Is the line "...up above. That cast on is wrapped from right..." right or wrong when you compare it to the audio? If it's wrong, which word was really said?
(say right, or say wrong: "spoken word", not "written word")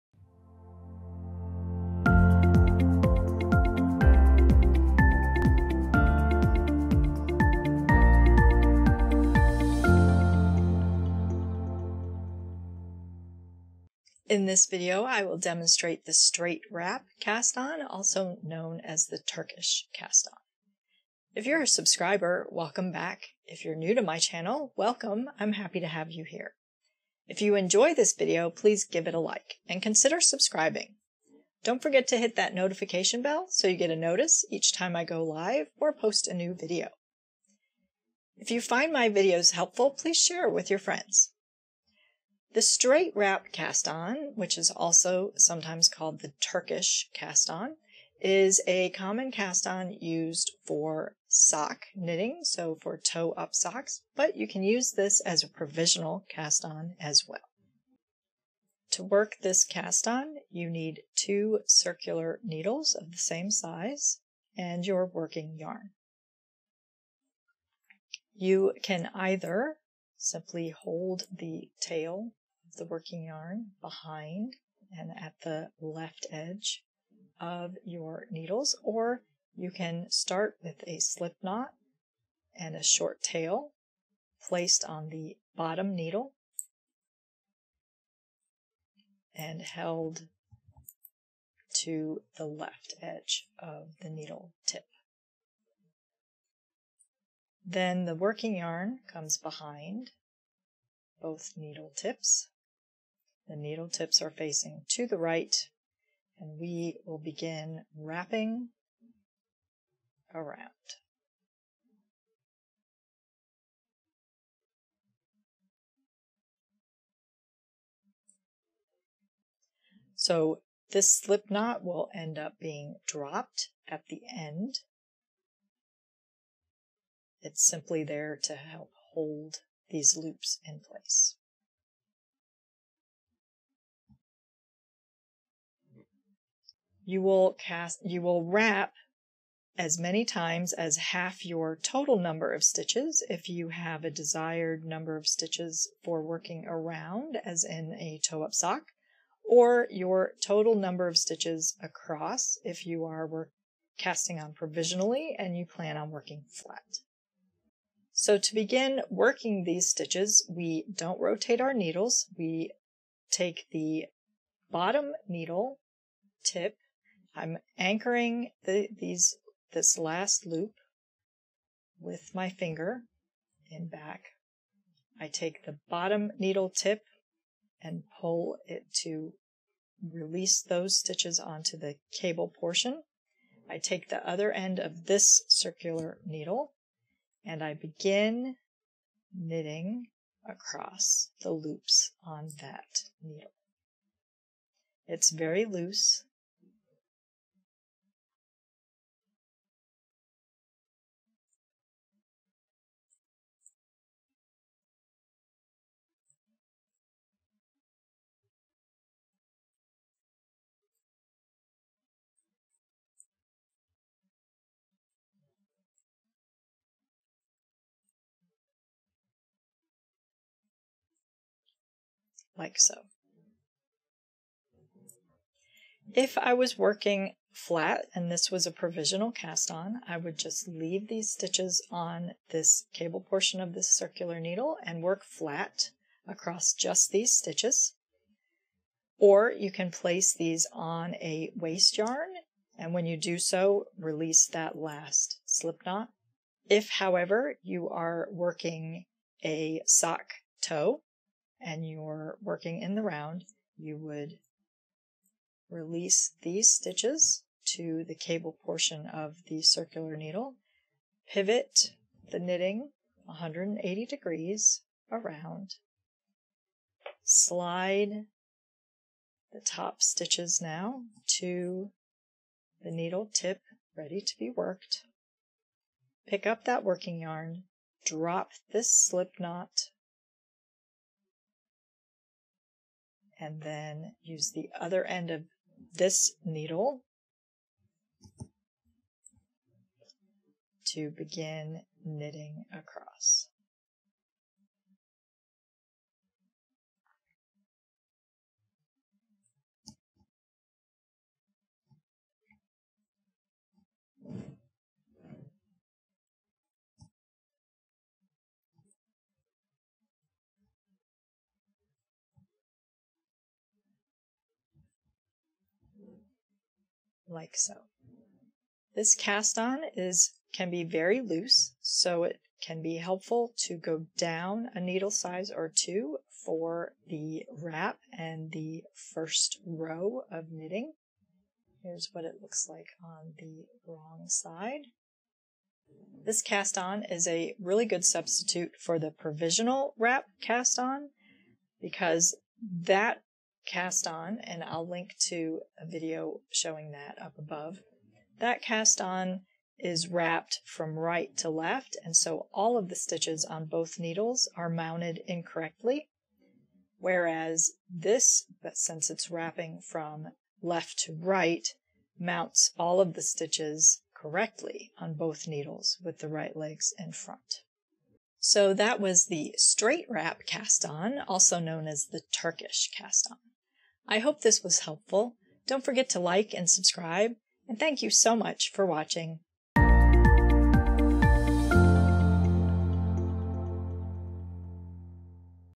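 right.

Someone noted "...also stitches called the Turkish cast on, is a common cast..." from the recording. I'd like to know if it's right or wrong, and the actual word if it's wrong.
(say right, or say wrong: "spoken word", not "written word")
wrong: "sometimes", not "stitches".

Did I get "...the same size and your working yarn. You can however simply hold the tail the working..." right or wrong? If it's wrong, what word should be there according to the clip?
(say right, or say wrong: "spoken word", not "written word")
wrong: "either", not "however".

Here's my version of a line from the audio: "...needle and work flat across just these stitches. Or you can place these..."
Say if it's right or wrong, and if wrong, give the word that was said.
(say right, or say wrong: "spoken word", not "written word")
right.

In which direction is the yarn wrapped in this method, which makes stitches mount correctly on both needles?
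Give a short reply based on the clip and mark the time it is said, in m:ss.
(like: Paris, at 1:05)
left to right, at 6:00.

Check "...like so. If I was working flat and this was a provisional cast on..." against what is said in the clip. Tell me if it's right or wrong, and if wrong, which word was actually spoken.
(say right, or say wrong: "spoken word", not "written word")
right.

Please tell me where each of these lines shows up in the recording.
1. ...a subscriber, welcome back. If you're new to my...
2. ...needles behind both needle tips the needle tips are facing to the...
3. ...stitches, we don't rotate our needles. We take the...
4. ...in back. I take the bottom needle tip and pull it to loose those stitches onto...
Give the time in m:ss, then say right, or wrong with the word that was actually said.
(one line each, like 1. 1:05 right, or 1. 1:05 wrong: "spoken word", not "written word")
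1. 0:21 right
2. 1:39 wrong: "comes", not "needles"
3. 2:39 right
4. 2:53 wrong: "release", not "loose".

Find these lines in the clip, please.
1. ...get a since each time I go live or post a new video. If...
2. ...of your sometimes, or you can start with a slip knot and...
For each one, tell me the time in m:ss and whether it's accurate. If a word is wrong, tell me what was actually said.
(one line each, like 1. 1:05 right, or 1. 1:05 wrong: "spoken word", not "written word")
1. 0:33 wrong: "notice", not "since"
2. 1:17 wrong: "needles", not "sometimes".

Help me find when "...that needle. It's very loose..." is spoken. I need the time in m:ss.
3:12.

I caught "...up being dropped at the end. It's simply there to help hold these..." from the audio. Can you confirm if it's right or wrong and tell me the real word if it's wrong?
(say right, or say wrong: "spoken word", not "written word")
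right.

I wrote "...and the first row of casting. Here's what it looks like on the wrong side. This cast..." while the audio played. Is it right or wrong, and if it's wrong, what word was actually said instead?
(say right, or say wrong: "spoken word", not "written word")
wrong: "knitting", not "casting".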